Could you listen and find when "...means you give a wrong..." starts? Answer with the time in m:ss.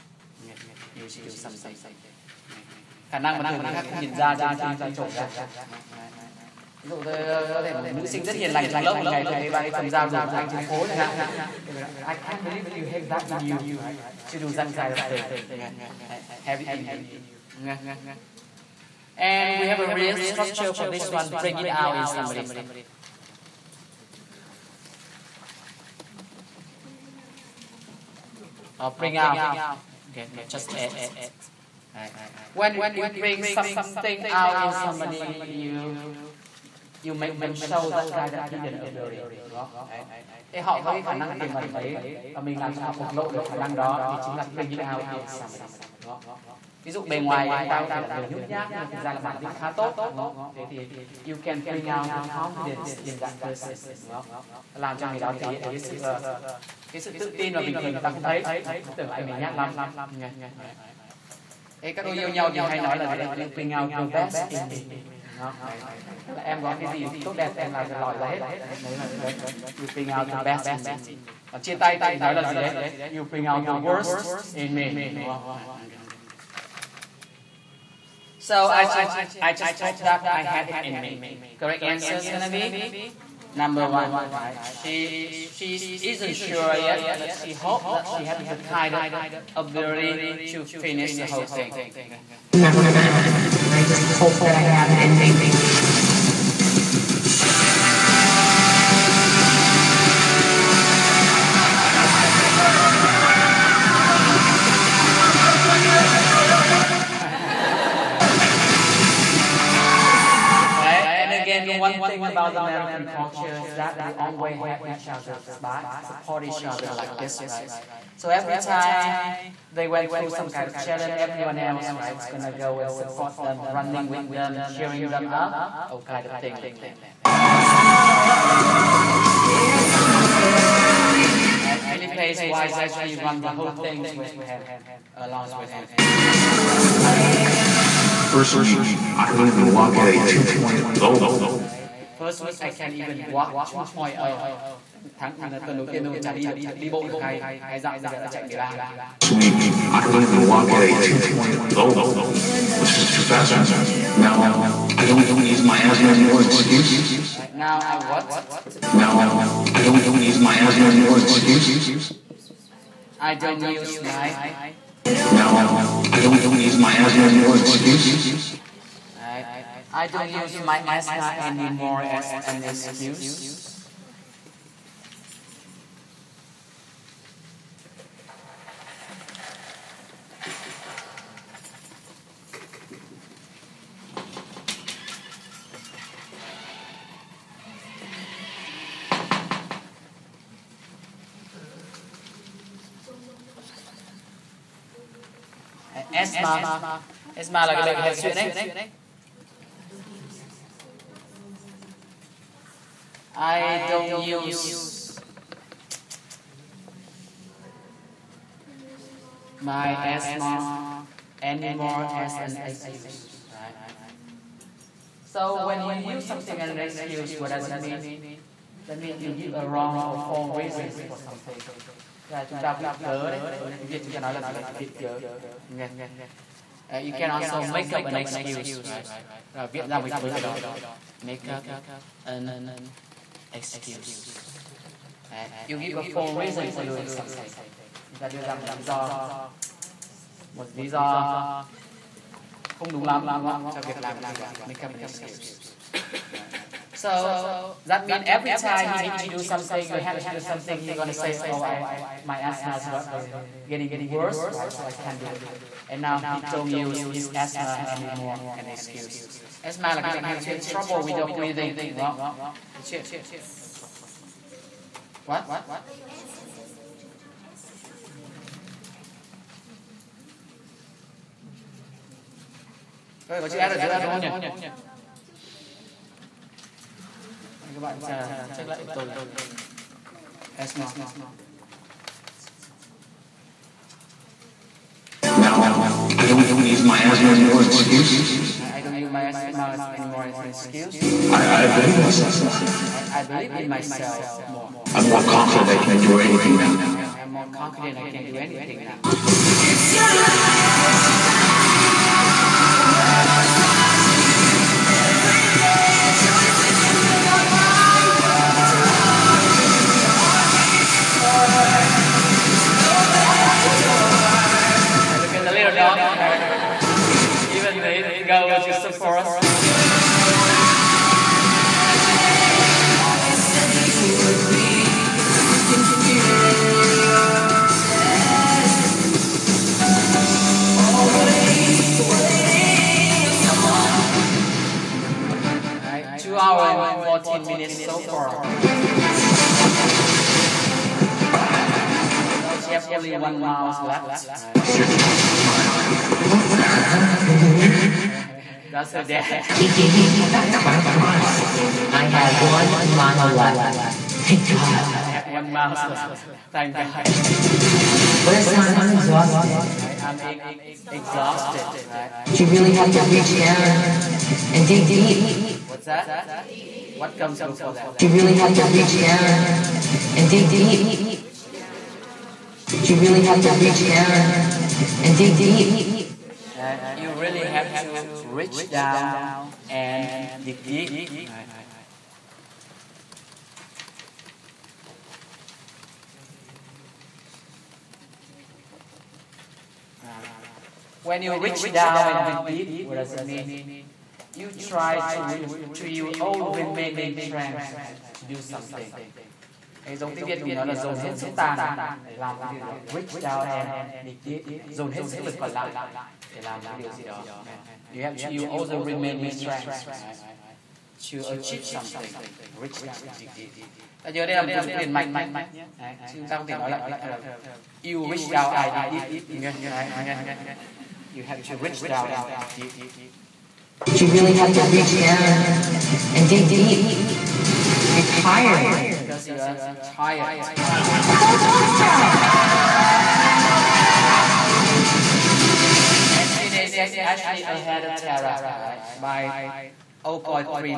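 3:38.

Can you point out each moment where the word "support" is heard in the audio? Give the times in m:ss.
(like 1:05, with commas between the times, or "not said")
1:55, 2:02.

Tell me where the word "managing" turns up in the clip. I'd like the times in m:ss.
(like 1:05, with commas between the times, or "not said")
not said.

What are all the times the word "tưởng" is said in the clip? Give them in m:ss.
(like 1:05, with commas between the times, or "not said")
0:58.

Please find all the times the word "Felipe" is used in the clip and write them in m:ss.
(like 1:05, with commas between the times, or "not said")
2:11.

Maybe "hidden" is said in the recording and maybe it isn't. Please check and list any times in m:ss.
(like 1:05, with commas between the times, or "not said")
0:38.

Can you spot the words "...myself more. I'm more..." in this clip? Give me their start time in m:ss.
4:53.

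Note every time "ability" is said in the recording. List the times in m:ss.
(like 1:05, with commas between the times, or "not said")
0:38, 1:29.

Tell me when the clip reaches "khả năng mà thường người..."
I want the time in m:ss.
0:03.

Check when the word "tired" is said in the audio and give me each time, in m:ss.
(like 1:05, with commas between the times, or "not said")
7:08.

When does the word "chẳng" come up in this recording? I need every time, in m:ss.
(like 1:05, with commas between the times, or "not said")
0:10.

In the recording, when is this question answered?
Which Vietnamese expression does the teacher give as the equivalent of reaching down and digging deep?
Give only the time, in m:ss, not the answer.
6:40.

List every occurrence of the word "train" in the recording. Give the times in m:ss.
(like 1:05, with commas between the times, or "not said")
not said.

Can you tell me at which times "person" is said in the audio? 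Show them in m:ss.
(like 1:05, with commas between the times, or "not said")
0:53.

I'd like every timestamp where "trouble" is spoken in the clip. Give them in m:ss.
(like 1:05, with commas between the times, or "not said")
4:20.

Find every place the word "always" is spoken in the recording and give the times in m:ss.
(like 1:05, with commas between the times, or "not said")
1:54.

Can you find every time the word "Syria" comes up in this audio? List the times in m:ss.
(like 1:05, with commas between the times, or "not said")
7:16.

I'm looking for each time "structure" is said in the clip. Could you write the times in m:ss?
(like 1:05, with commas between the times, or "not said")
0:20.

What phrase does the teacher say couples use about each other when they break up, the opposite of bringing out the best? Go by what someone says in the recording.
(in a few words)
you bring out the worst in me.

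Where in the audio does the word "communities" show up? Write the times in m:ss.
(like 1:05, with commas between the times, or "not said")
not said.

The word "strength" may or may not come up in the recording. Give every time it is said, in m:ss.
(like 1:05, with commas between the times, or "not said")
6:37, 6:49.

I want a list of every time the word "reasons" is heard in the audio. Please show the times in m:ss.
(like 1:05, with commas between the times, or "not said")
3:40, 3:56.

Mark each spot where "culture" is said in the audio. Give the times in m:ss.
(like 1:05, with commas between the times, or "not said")
1:53.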